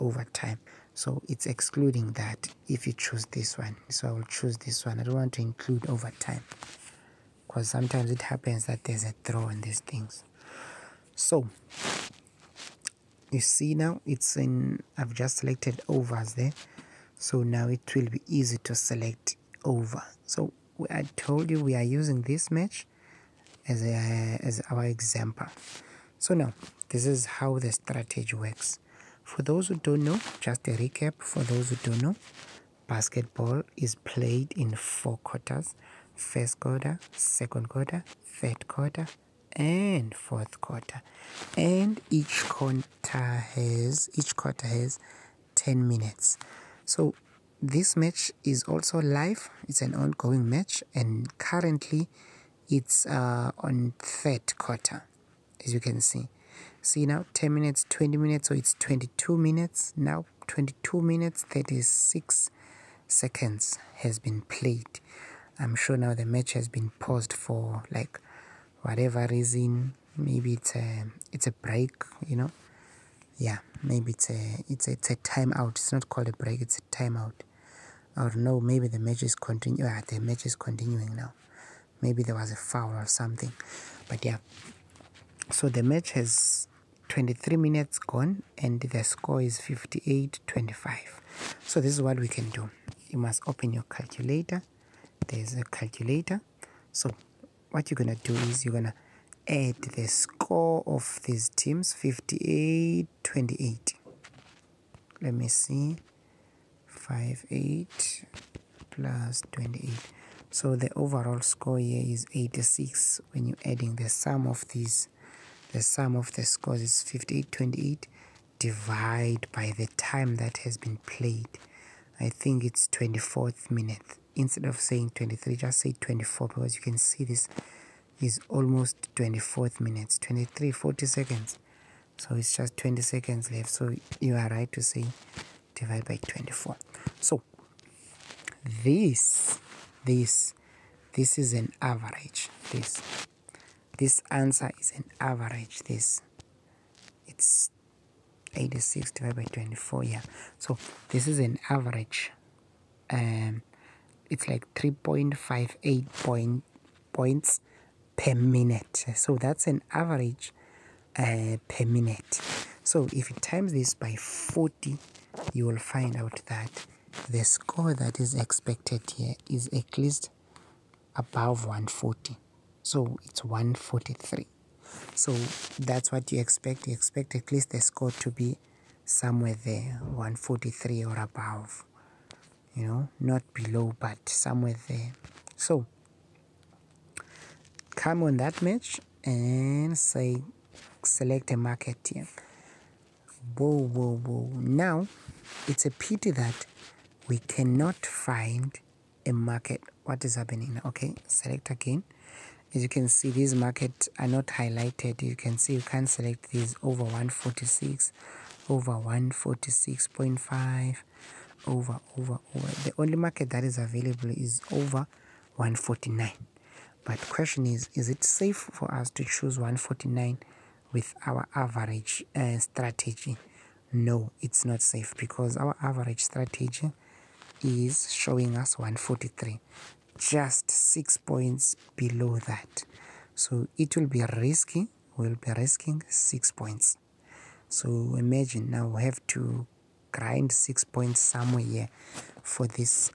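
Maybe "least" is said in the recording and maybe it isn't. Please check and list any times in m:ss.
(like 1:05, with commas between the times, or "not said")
2:49, 2:57.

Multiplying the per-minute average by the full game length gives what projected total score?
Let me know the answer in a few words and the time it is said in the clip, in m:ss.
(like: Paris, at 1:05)
143, at 2:52.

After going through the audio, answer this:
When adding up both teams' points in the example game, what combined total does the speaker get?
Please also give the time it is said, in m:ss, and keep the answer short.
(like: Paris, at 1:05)
86, at 1:50.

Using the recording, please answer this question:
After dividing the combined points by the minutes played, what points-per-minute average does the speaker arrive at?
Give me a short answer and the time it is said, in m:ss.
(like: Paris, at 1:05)
3.58, at 2:34.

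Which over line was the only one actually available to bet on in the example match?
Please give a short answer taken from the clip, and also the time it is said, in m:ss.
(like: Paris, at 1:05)
149, at 3:34.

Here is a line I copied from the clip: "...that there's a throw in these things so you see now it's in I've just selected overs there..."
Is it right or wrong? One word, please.
right.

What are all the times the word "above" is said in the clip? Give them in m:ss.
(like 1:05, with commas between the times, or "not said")
2:51, 3:01.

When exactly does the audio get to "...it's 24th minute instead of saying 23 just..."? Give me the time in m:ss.
2:02.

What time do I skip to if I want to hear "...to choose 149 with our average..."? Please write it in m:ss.
3:39.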